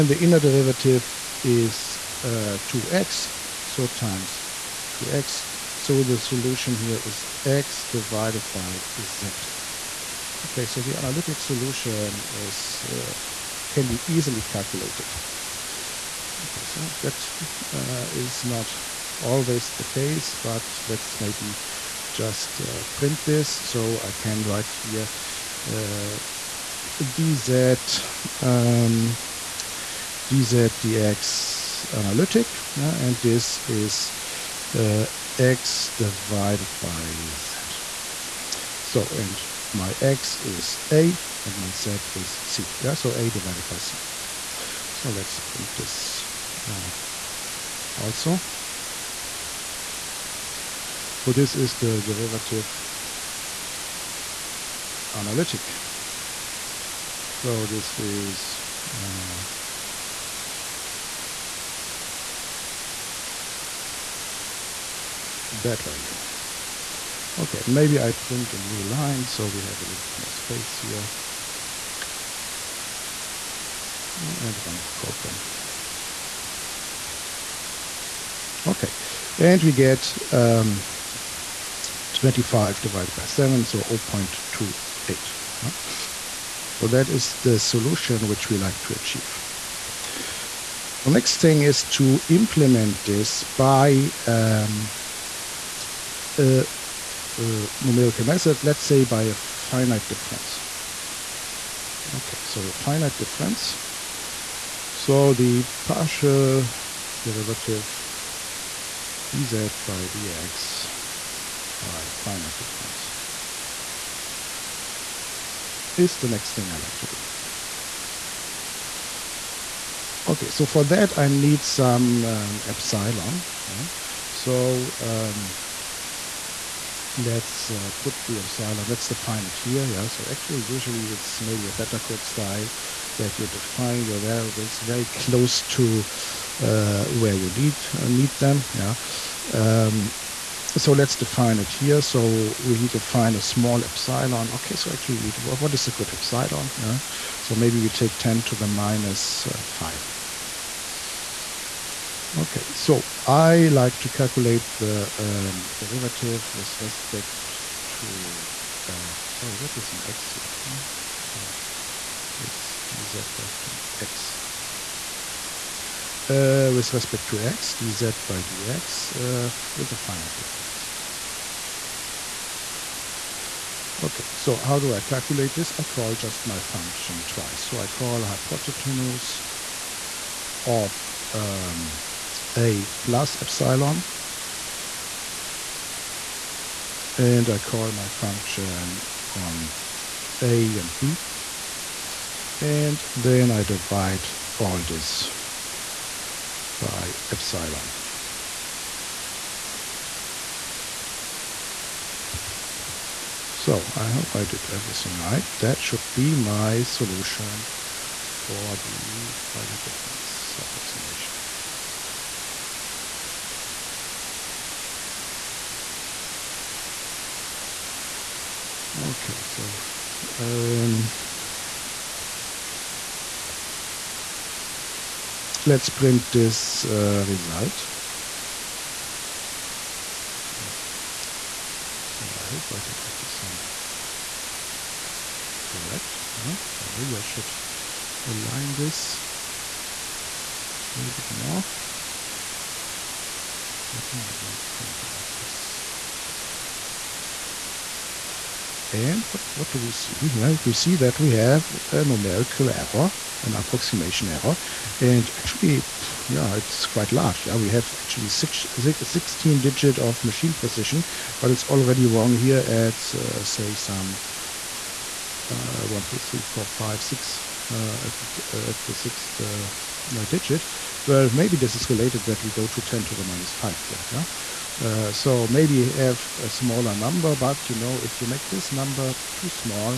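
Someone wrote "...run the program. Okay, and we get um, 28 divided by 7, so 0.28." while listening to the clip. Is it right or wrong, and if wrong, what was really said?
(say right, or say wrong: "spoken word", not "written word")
wrong: "25", not "28".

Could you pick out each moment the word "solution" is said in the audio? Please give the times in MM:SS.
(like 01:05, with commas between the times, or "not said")
00:06, 00:11, 01:27, 03:26.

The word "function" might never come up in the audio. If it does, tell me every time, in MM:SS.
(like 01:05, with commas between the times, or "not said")
02:56, 03:08.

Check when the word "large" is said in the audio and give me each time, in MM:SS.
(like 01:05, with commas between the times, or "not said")
04:17.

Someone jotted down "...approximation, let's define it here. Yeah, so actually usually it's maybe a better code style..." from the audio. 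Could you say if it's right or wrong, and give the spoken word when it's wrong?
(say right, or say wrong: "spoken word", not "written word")
wrong: "epsilon", not "approximation".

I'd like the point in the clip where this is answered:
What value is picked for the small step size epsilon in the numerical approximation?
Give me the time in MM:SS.
02:28.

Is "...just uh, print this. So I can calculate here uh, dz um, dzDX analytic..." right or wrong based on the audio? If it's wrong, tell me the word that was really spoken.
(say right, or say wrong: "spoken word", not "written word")
wrong: "write", not "calculate".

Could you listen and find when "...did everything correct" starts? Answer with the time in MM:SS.
03:52.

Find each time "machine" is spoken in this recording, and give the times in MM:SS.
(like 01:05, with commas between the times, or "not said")
04:20.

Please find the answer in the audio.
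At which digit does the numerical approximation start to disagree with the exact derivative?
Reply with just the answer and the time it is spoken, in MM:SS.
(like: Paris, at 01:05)
sixth, at 04:28.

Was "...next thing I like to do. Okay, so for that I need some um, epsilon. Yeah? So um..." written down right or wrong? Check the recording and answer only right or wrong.
right.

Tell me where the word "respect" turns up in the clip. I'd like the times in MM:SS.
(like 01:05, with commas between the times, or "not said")
02:36, 02:46.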